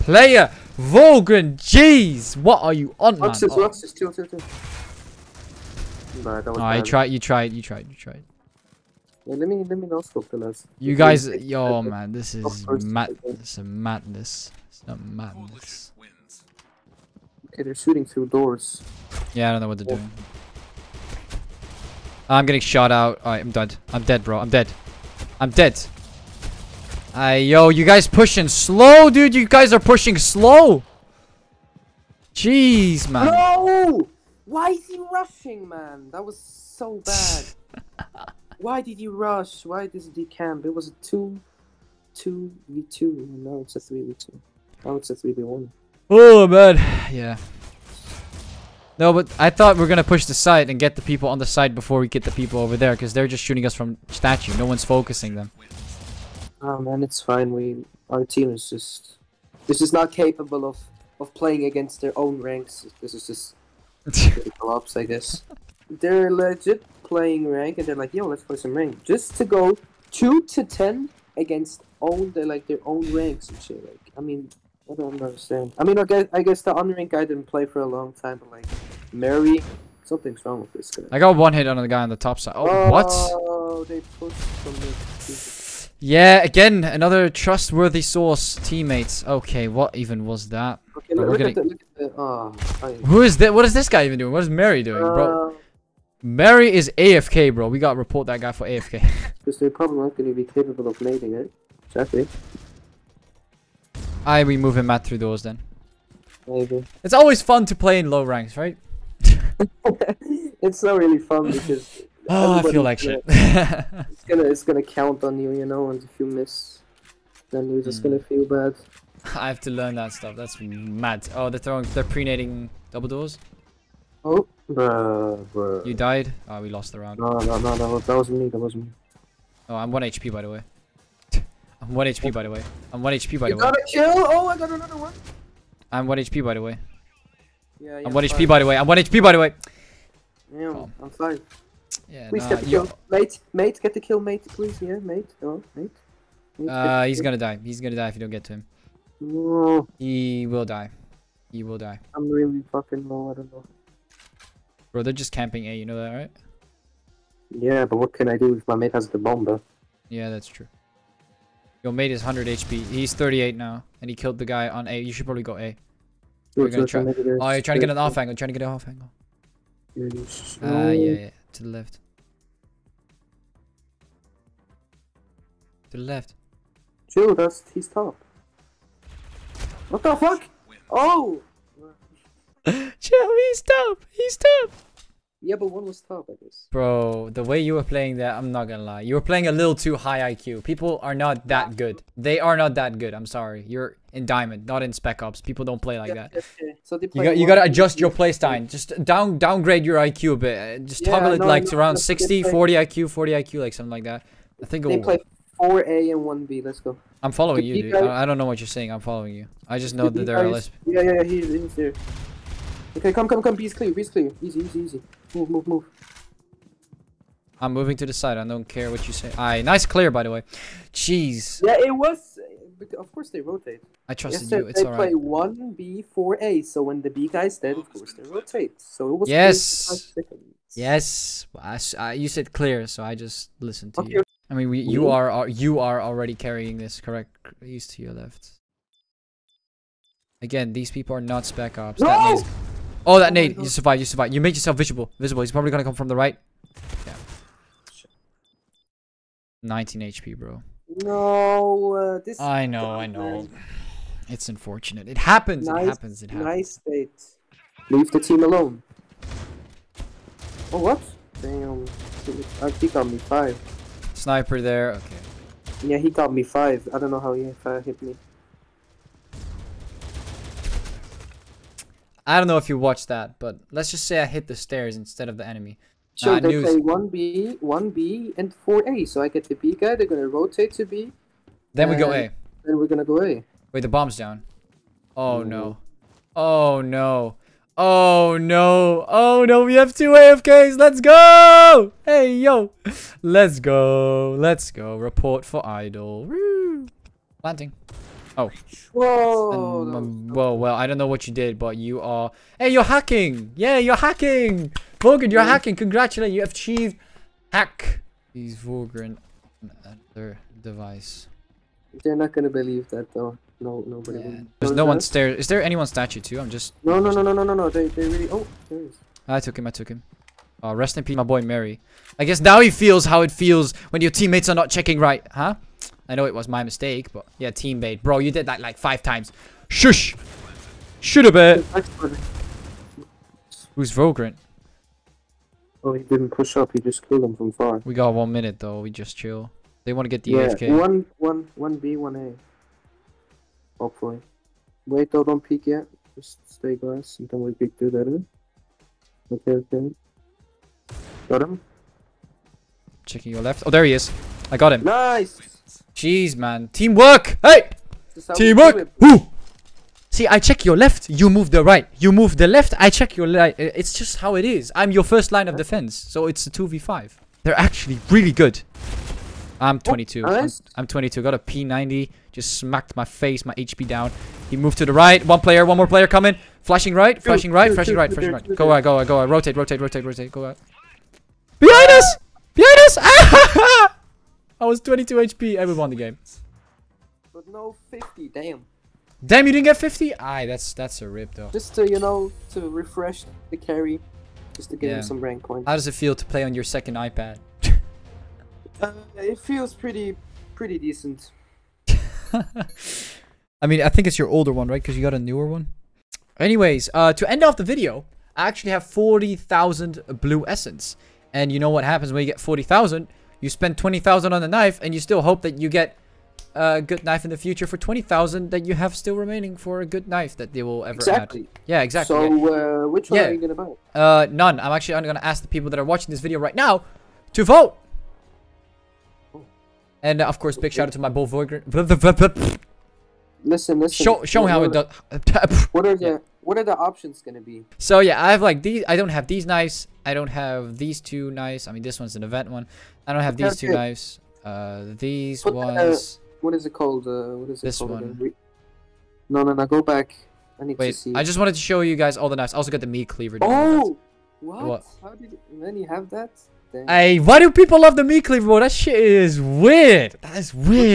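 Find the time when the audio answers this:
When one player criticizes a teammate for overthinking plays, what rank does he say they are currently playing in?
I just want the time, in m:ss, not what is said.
3:14.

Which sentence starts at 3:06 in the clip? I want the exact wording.
Bro, the way you were playing that, I'm not gonna lie.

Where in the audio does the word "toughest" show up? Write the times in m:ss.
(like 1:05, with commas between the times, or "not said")
not said.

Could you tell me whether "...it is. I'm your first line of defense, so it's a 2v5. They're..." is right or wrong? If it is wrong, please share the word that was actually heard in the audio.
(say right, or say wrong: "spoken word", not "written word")
right.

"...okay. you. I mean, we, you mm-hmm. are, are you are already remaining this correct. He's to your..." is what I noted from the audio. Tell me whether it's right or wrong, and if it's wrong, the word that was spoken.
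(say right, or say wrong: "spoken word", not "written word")
wrong: "carrying", not "remaining".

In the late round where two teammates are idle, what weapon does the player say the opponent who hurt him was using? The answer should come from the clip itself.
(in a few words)
P90.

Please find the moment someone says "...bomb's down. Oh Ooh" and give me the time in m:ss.
4:43.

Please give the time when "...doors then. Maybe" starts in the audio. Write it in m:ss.
1:45.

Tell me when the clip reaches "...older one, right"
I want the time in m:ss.
6:44.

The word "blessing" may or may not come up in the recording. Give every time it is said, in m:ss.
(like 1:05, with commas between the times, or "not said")
not said.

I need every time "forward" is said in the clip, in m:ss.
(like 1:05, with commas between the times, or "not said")
not said.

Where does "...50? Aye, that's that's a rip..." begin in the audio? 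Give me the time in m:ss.
6:29.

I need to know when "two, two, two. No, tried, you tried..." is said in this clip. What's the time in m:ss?
0:04.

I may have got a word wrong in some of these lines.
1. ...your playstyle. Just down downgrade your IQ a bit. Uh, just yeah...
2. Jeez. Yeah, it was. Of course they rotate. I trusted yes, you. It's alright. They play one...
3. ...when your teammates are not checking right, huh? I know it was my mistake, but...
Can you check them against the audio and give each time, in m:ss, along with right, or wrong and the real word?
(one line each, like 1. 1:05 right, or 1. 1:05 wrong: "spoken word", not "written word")
1. 3:17 right
2. 3:40 right
3. 5:23 right.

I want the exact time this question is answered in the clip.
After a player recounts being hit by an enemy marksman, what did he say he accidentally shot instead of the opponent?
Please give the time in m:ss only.
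4:34.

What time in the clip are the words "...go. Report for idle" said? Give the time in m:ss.
4:54.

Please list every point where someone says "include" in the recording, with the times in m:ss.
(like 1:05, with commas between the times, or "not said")
not said.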